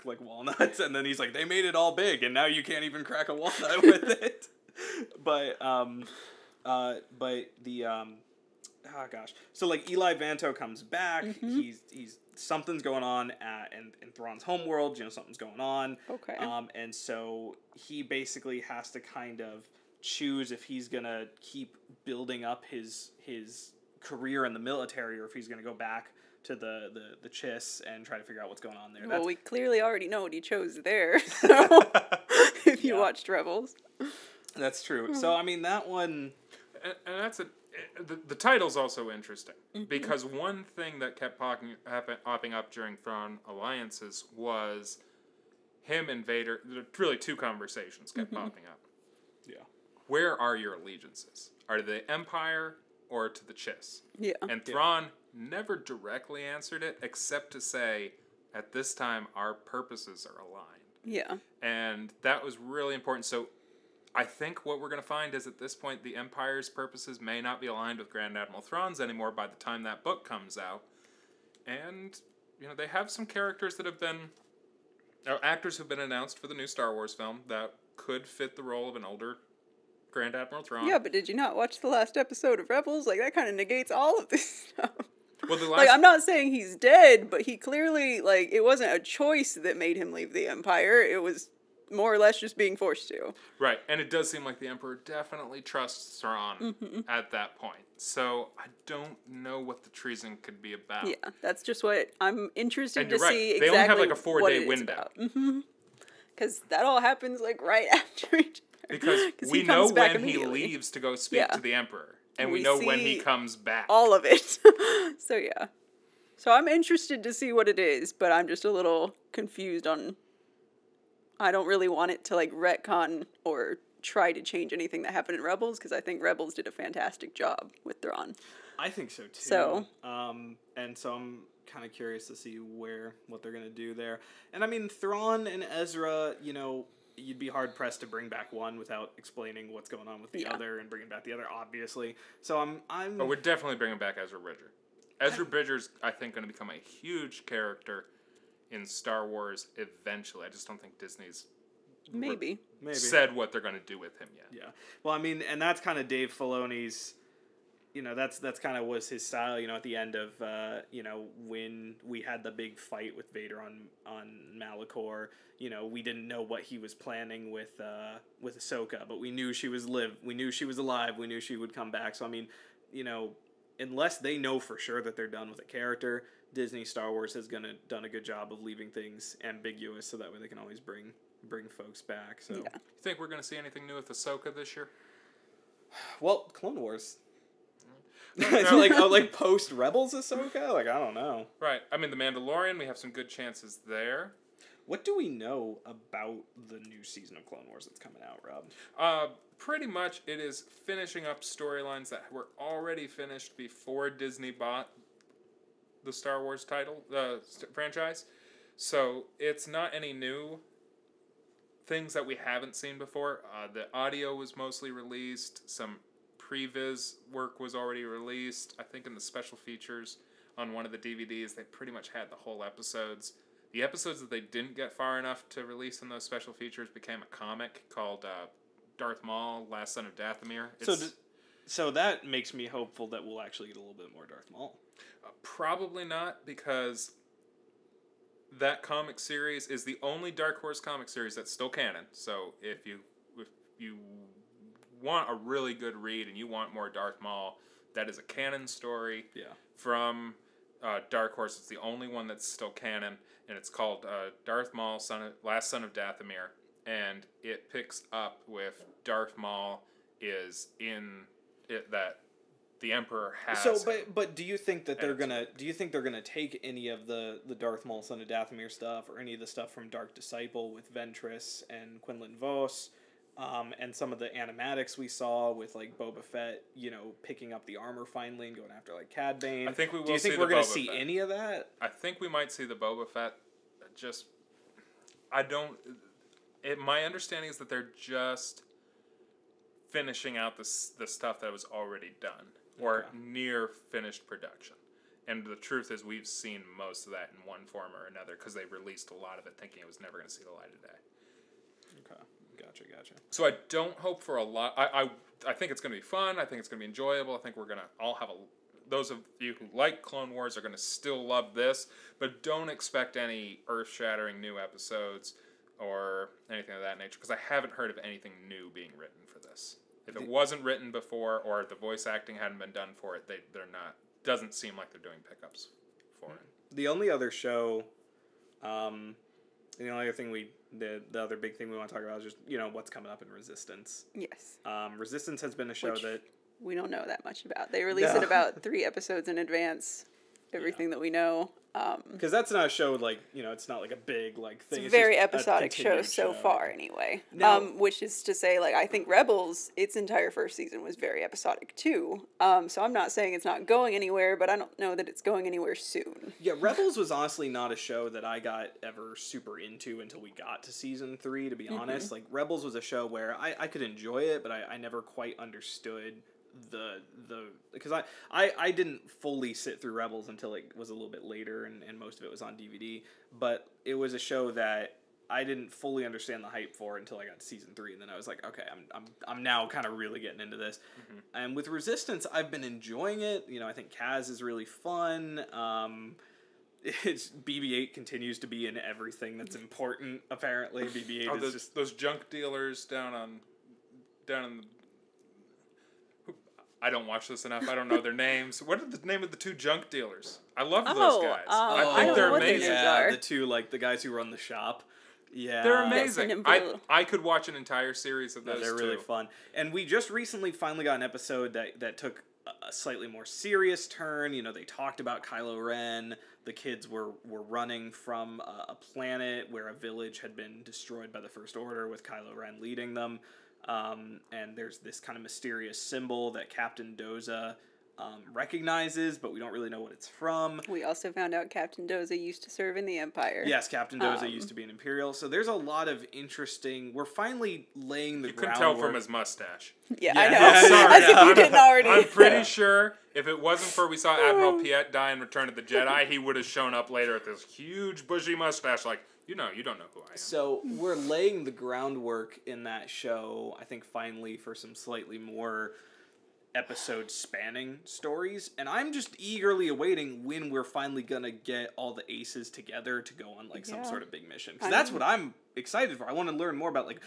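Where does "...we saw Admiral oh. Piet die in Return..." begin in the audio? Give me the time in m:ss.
7:23.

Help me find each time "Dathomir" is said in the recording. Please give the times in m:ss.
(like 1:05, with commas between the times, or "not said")
3:50, 4:15, 4:28.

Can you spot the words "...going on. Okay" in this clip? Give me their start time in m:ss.
0:15.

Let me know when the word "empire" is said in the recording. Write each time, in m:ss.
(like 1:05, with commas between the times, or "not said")
0:52, 1:06, 1:30, 7:12.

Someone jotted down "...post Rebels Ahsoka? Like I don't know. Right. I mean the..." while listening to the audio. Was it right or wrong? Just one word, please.
right.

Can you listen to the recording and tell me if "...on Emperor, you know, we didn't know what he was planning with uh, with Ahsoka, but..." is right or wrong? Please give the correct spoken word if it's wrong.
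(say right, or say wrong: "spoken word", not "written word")
wrong: "Malachor", not "Emperor".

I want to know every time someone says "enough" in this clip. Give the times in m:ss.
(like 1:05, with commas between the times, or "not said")
3:45, 6:37.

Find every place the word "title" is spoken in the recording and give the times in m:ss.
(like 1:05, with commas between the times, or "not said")
0:38, 3:26.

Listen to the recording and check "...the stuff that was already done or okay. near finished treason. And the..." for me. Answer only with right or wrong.
wrong.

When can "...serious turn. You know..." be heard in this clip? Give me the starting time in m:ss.
6:53.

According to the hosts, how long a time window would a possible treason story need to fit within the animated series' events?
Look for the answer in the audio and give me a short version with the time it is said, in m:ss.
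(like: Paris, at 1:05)
4 days, at 1:44.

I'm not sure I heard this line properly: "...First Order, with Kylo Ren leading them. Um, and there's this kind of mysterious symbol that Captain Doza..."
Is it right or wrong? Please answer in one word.
right.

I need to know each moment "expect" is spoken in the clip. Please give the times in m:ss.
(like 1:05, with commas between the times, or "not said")
5:12.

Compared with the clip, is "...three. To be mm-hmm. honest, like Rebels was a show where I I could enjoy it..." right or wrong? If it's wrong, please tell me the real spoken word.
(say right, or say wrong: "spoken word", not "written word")
right.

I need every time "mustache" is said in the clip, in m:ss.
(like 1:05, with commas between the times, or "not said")
7:19, 7:28.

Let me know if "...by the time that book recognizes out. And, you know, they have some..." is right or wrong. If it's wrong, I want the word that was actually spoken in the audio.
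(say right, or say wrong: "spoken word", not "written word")
wrong: "comes", not "recognizes".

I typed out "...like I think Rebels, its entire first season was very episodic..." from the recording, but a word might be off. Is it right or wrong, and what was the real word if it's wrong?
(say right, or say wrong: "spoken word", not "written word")
right.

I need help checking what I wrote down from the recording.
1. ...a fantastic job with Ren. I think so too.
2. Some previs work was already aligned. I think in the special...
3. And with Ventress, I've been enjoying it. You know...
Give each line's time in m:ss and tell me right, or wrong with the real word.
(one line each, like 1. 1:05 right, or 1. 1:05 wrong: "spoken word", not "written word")
1. 2:06 wrong: "Thrawn", not "Ren"
2. 3:35 wrong: "released", not "aligned"
3. 6:21 wrong: "Resistance", not "Ventress".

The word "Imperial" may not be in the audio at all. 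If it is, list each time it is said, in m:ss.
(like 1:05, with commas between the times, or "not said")
7:14.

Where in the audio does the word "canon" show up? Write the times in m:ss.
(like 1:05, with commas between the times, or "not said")
4:01, 4:08, 4:12.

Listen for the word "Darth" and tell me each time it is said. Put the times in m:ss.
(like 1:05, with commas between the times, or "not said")
3:48, 3:54, 4:06, 4:14, 4:19, 4:27.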